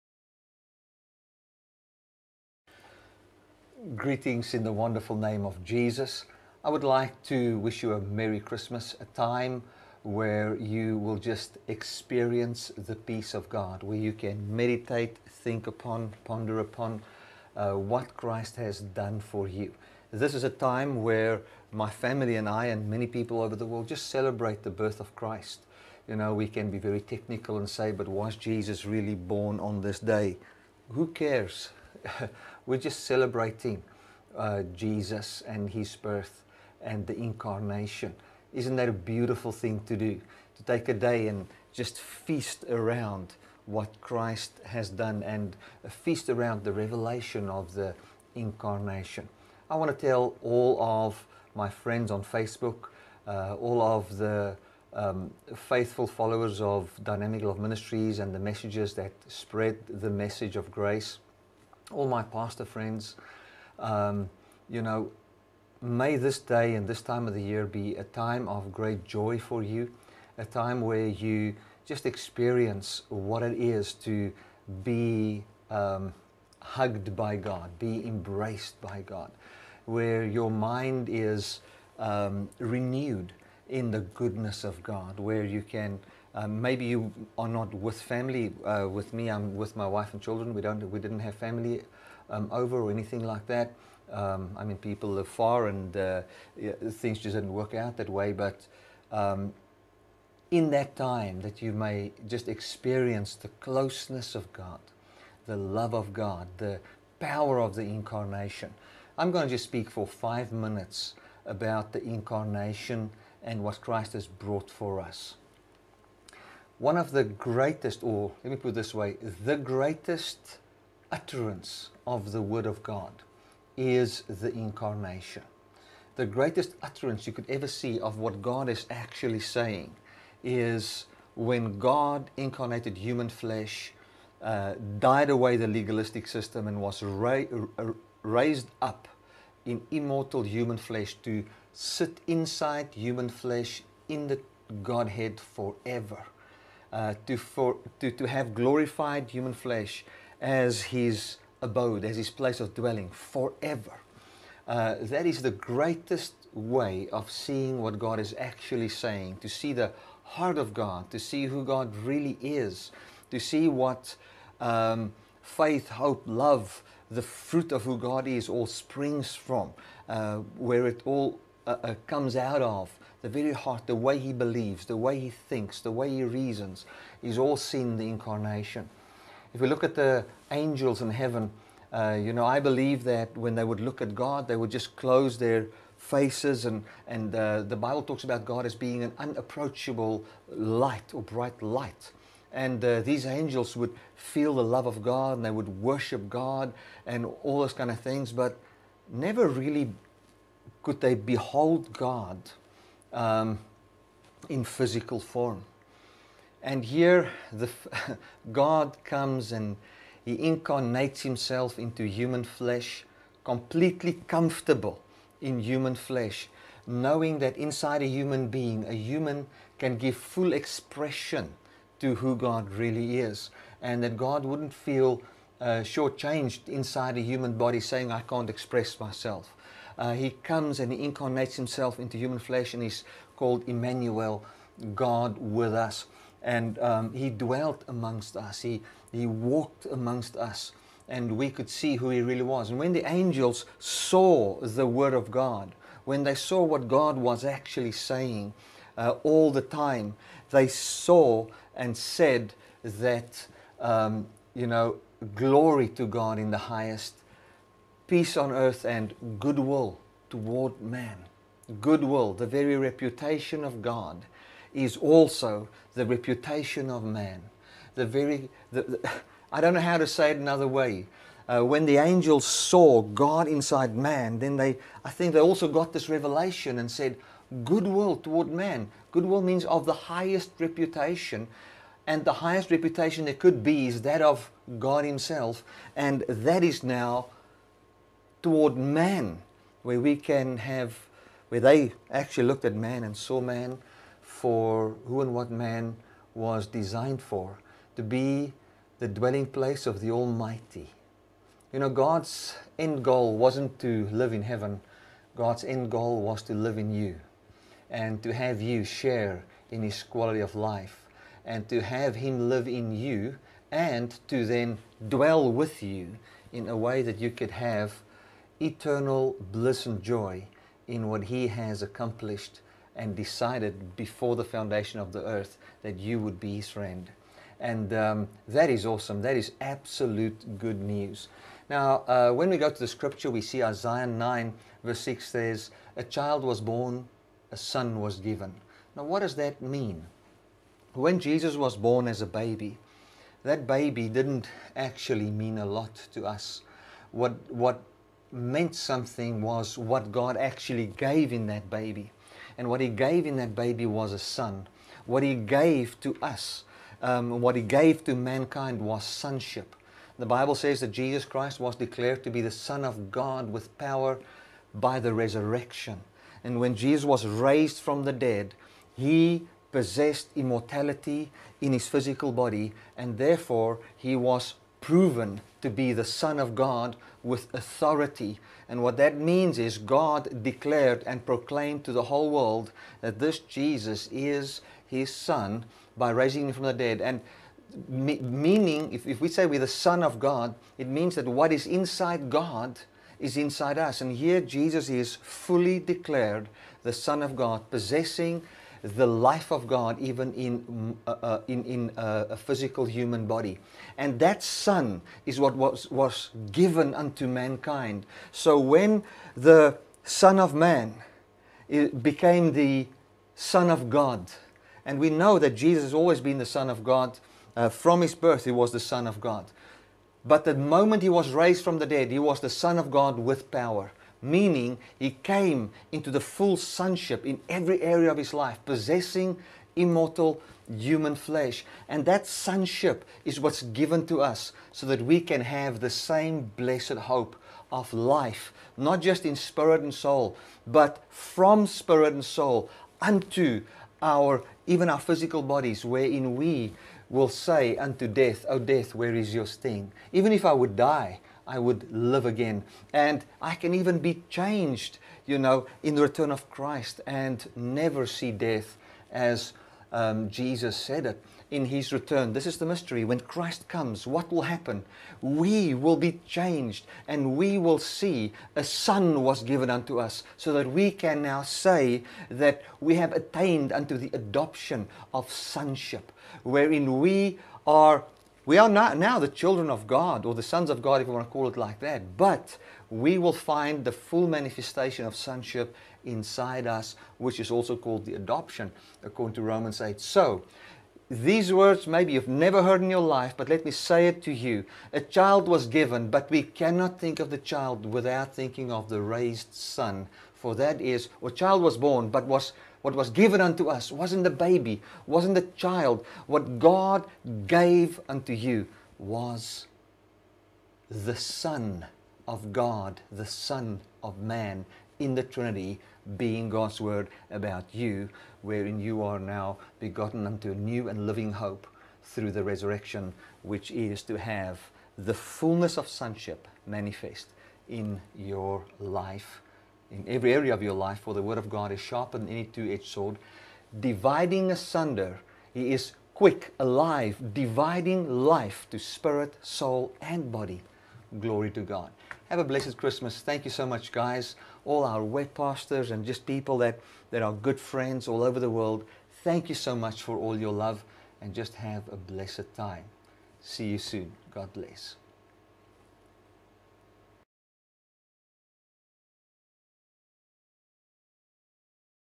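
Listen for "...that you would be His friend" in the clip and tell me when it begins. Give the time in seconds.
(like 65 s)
325 s.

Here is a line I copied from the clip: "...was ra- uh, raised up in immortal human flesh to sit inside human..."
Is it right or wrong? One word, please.
right.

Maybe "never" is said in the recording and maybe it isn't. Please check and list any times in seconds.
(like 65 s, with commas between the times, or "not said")
199 s, 457 s, 492 s.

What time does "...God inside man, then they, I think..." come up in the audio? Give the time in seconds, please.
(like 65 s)
273 s.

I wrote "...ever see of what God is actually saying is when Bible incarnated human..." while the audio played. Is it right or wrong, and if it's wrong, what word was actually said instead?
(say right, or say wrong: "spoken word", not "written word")
wrong: "God", not "Bible".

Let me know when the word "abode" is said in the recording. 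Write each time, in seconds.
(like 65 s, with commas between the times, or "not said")
151 s.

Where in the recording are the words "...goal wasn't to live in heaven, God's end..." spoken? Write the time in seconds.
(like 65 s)
303 s.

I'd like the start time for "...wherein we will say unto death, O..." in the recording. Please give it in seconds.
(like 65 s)
445 s.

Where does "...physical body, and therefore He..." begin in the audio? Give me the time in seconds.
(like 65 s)
371 s.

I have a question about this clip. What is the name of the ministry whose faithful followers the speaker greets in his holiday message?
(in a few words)
Dynamic Love Ministries.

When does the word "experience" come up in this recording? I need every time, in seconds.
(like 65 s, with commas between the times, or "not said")
11 s, 72 s, 102 s.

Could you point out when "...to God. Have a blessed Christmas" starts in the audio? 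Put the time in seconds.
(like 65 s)
541 s.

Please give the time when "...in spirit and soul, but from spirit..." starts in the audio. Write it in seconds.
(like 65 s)
439 s.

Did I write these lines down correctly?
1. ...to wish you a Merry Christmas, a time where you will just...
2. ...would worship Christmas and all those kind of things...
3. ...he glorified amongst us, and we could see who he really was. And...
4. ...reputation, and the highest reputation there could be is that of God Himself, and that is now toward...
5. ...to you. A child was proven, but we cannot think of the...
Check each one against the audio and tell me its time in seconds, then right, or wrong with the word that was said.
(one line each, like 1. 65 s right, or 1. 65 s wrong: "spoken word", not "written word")
1. 7 s right
2. 195 s wrong: "God", not "Christmas"
3. 239 s wrong: "walked", not "glorified"
4. 280 s right
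5. 494 s wrong: "given", not "proven".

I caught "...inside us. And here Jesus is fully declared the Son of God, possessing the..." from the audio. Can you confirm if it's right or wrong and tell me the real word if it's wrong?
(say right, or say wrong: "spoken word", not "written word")
right.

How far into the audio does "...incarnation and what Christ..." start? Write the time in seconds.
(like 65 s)
112 s.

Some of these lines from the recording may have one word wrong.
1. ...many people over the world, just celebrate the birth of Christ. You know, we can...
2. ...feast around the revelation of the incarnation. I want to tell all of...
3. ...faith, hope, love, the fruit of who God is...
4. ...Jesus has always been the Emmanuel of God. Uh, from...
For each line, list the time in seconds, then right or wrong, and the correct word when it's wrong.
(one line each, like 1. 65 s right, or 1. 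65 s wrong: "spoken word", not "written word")
1. 22 s right
2. 45 s right
3. 165 s right
4. 415 s wrong: "Son", not "Emmanuel".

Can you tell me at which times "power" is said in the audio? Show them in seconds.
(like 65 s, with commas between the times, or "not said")
107 s, 363 s, 423 s.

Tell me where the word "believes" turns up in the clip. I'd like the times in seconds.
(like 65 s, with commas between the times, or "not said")
174 s, 182 s.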